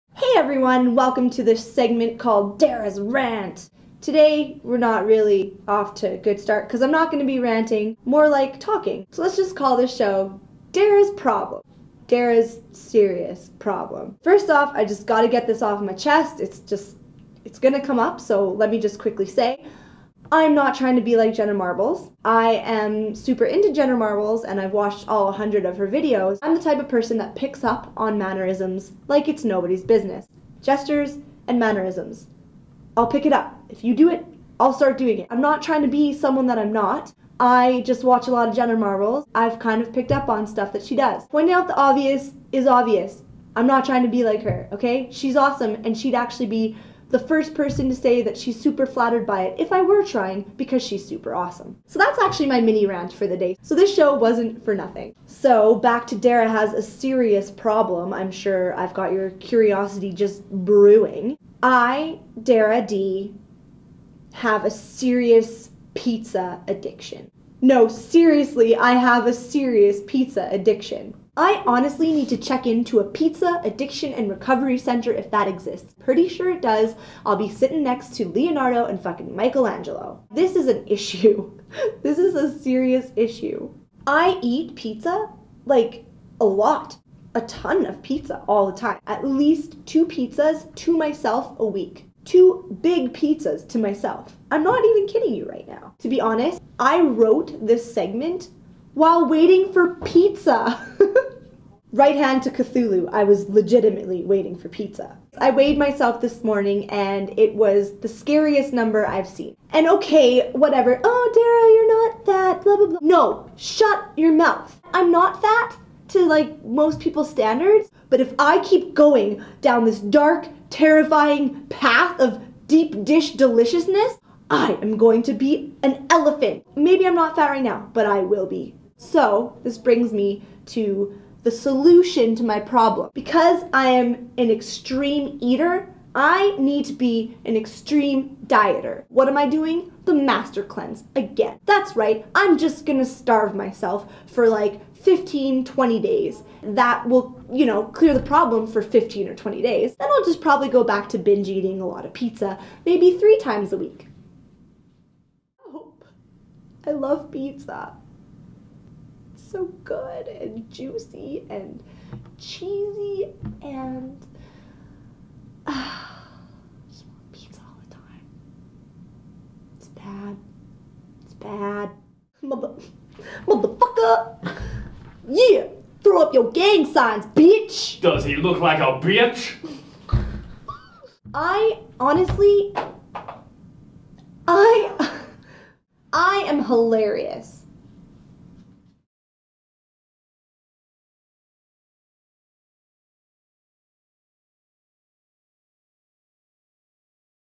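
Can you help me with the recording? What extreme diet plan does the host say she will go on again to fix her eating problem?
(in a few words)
The master cleanse.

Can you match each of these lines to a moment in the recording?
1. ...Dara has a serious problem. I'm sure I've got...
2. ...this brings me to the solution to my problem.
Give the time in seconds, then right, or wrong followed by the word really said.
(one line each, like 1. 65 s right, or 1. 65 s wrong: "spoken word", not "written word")
1. 56 s right
2. 129 s right.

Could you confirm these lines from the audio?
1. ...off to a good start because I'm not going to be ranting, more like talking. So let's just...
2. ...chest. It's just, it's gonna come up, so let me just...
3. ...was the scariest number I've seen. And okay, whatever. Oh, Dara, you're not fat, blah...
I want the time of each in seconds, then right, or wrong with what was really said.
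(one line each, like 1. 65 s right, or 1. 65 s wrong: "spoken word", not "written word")
1. 5 s right
2. 15 s right
3. 107 s right.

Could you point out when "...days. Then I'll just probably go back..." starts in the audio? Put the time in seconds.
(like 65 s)
149 s.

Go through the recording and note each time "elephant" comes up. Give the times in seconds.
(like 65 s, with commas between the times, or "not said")
126 s.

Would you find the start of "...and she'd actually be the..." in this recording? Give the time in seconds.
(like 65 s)
45 s.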